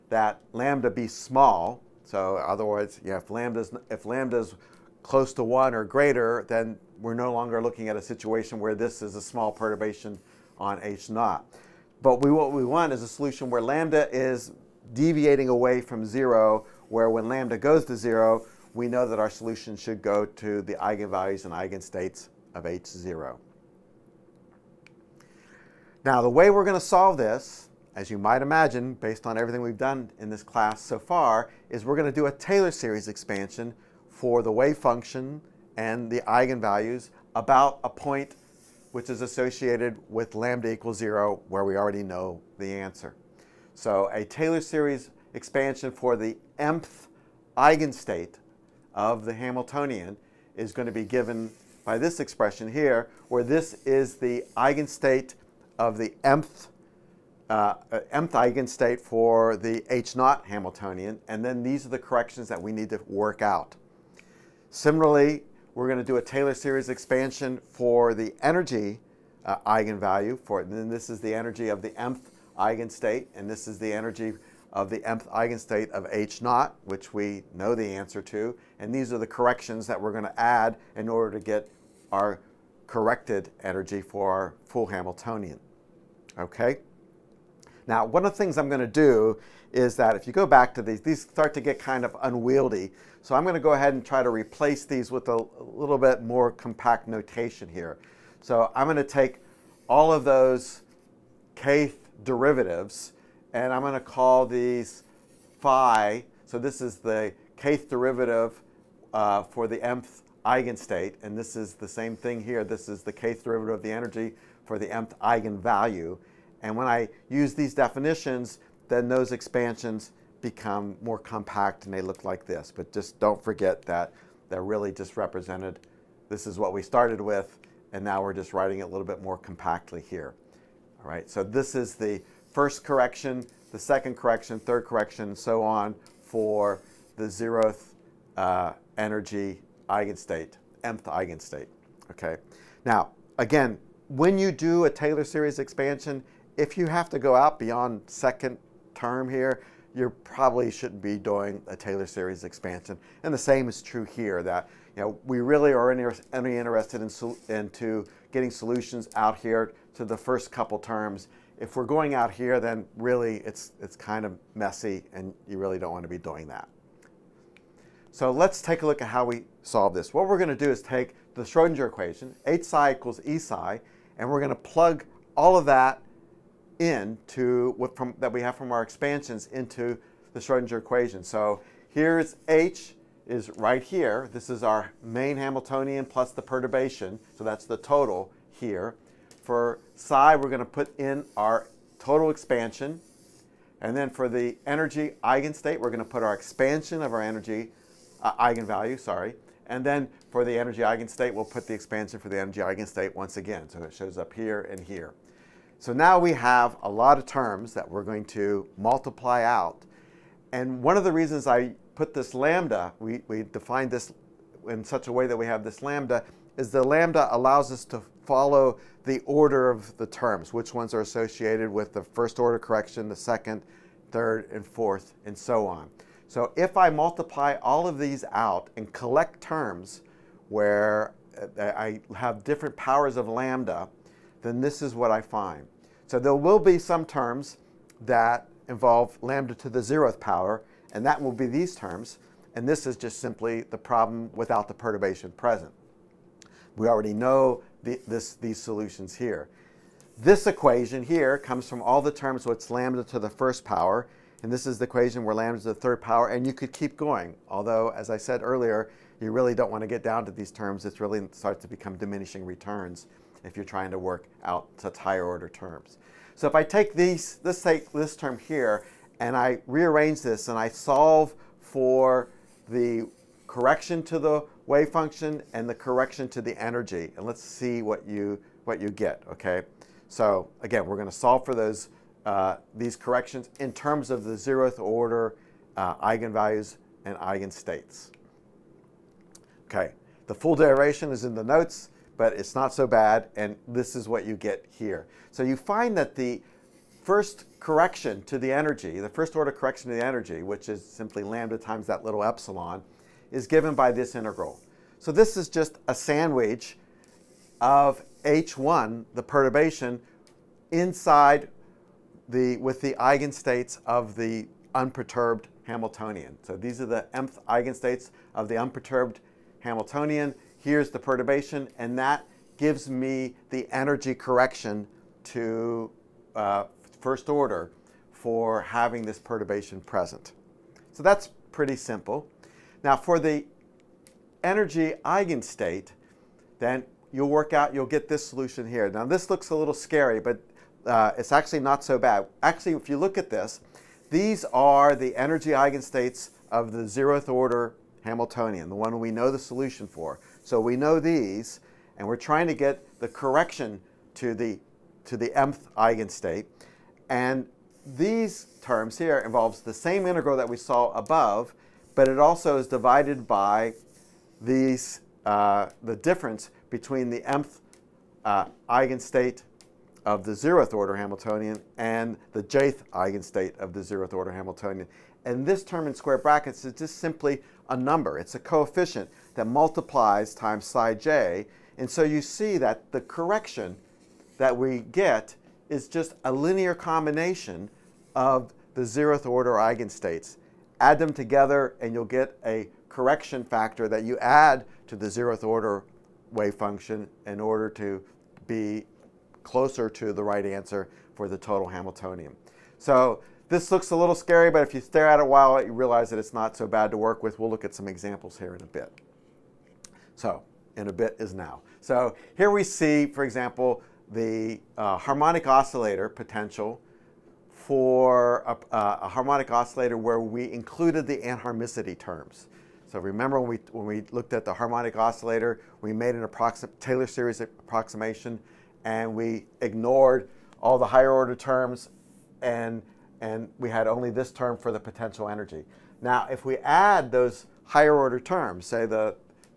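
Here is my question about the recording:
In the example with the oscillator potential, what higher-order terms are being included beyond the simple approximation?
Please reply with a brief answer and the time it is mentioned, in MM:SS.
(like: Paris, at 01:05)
anharmonicity terms, at 07:01.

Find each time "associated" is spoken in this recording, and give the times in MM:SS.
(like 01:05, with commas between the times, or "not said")
00:39, 03:41.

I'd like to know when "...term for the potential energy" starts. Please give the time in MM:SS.
07:14.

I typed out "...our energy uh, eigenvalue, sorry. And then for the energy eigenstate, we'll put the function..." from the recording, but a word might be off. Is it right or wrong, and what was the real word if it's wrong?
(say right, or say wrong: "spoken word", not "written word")
wrong: "expansion", not "function".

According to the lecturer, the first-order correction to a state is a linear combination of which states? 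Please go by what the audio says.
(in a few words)
zeroth order eigenstates.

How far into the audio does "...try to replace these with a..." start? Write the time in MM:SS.
01:34.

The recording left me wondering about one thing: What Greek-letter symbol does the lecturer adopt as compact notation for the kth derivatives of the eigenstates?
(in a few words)
phi.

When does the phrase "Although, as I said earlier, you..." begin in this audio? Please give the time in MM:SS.
04:17.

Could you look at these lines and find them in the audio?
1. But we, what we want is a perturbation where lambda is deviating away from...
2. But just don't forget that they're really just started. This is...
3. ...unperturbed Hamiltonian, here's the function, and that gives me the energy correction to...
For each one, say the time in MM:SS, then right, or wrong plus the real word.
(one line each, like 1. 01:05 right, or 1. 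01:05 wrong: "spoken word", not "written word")
1. 00:12 wrong: "solution", not "perturbation"
2. 02:02 wrong: "represented", not "started"
3. 05:18 wrong: "perturbation", not "function".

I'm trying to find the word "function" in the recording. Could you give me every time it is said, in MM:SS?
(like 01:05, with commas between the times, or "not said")
00:34, 04:34, 06:36.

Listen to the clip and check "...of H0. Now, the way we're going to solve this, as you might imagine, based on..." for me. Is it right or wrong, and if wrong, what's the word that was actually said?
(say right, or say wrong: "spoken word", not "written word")
right.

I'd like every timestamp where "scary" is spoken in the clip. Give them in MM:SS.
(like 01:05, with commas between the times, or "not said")
05:39, 06:44.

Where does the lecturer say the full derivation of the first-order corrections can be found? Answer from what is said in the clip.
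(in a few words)
in the notes.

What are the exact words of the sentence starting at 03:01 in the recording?
So here's H is right here.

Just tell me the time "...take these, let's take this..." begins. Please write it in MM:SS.
04:26.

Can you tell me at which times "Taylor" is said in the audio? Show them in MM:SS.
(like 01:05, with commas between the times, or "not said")
00:32, 00:44, 01:06, 02:24, 02:31, 07:06.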